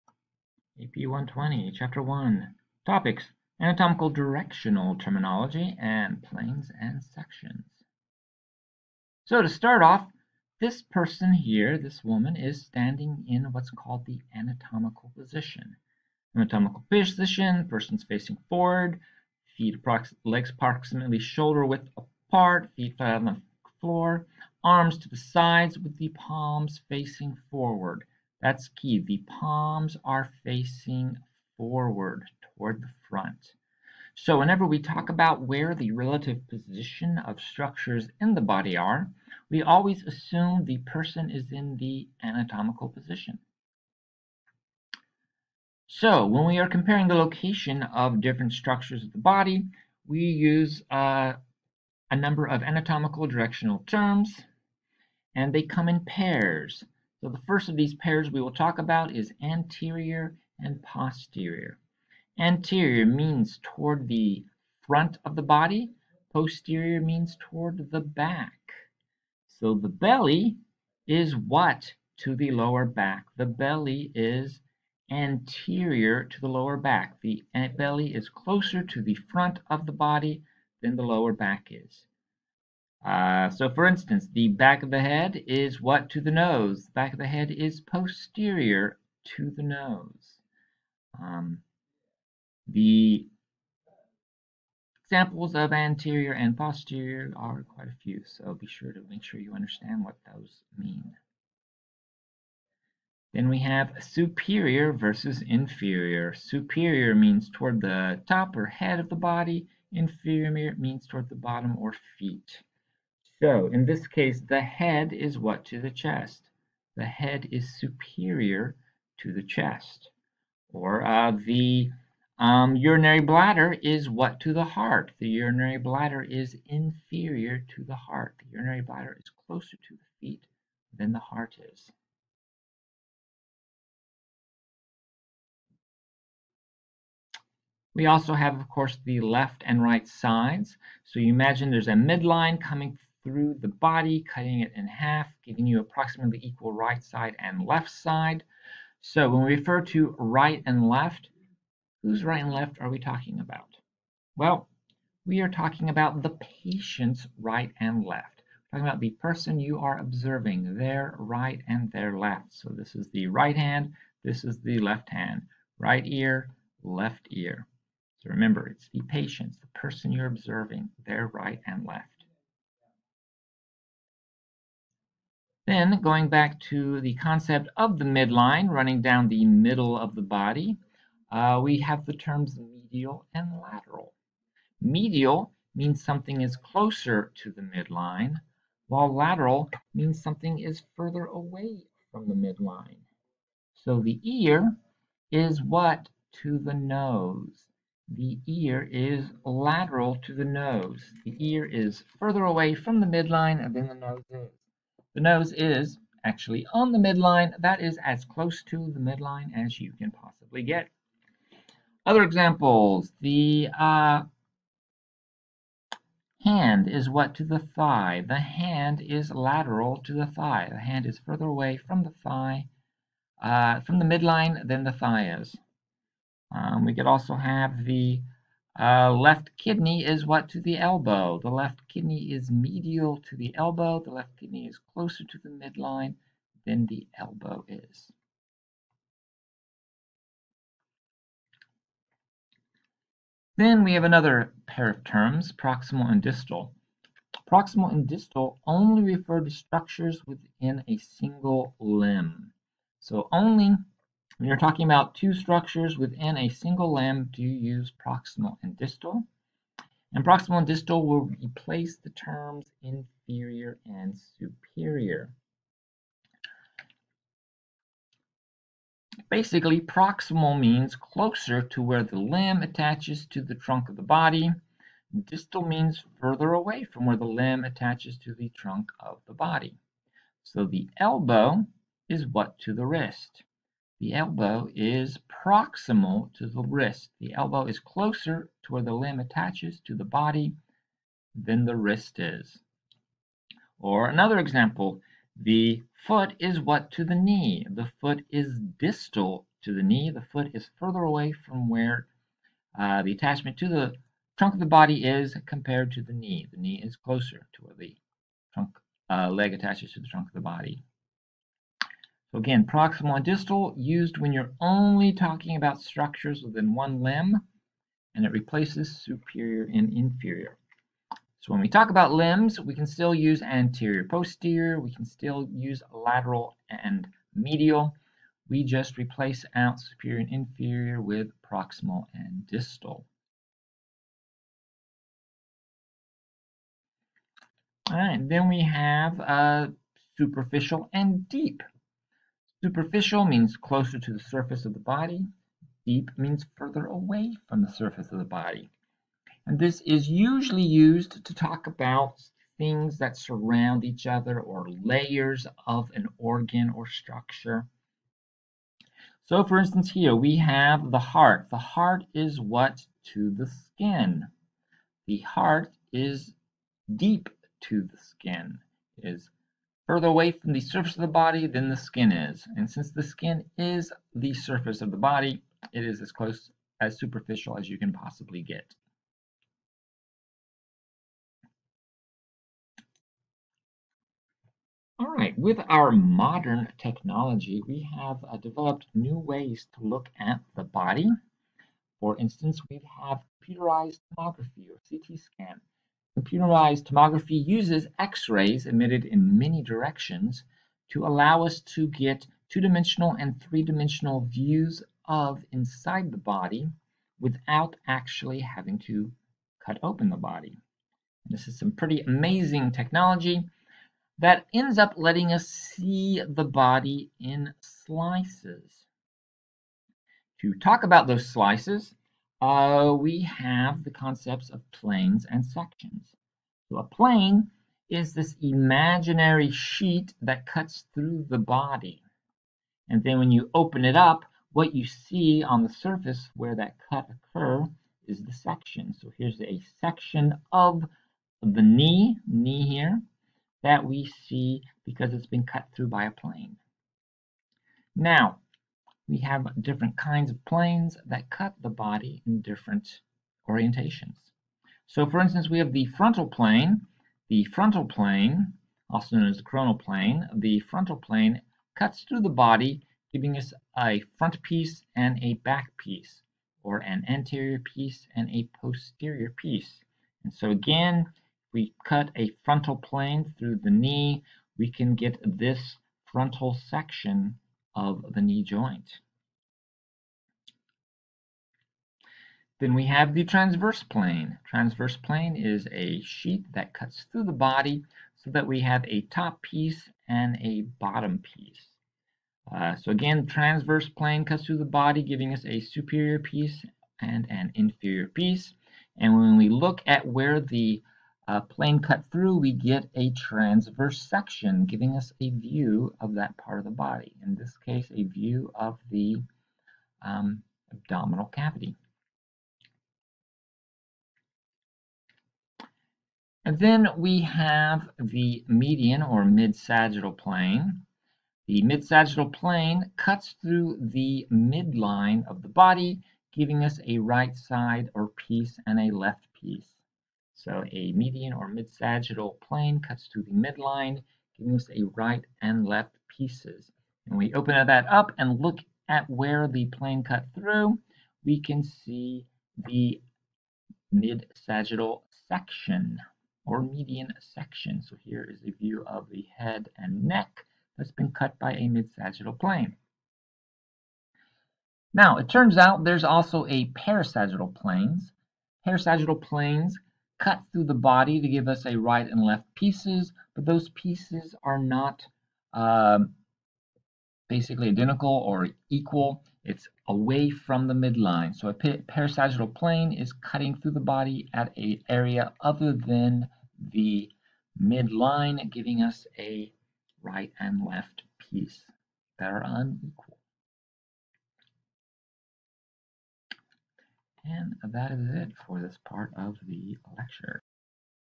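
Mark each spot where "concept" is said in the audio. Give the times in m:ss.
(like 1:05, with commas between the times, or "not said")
2:57, 7:03.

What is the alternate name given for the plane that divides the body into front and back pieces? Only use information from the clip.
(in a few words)
Coronal plane.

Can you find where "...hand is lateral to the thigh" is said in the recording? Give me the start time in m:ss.
3:38.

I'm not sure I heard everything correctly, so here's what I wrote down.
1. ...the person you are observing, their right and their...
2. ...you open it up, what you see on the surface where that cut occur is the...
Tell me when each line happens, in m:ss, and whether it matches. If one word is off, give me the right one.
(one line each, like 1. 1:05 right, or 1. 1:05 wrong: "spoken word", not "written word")
1. 2:39 right
2. 7:13 right.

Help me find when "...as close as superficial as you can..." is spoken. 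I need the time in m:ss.
6:16.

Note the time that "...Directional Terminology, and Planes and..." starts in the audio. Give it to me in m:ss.
0:04.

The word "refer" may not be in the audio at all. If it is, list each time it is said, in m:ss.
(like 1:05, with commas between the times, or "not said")
2:29, 4:09.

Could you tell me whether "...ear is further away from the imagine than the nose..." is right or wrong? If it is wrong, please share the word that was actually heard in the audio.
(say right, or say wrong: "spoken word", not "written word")
wrong: "midline", not "imagine".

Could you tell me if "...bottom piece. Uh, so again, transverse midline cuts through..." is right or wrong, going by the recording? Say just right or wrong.
wrong.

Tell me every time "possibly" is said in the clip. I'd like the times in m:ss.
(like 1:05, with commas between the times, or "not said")
3:30, 6:17.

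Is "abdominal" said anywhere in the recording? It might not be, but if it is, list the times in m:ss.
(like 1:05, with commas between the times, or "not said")
8:30.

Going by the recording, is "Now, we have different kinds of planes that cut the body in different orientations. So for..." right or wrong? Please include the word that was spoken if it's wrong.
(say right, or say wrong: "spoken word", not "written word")
right.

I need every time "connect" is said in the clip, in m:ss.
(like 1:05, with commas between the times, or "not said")
not said.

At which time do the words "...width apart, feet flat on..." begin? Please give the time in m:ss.
0:21.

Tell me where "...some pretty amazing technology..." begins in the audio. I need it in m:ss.
6:51.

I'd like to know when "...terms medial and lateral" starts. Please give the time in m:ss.
3:02.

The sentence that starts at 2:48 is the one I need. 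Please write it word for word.
So remember, it's the patient, the person you're observing, their right and left.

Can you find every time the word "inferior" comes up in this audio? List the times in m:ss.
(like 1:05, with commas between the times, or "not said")
1:45, 1:49, 2:06, 4:22, 5:19, 5:30, 8:17.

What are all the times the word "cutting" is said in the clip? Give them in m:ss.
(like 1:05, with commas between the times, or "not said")
2:24, 9:33.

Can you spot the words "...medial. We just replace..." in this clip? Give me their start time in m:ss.
5:27.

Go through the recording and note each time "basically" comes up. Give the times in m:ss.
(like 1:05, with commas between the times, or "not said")
4:29, 9:27.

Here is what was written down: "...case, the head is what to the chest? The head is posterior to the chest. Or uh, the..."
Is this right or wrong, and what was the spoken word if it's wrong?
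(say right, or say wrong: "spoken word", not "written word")
wrong: "superior", not "posterior".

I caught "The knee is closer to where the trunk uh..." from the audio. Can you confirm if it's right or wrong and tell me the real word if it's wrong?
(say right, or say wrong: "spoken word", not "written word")
right.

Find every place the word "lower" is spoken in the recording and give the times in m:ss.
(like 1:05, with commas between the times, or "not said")
1:12, 1:16, 1:21.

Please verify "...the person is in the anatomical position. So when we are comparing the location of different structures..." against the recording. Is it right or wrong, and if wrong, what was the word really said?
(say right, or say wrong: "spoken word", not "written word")
right.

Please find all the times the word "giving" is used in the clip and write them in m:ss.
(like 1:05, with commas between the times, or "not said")
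2:25, 7:43, 8:15, 8:24, 8:46, 8:54, 9:38.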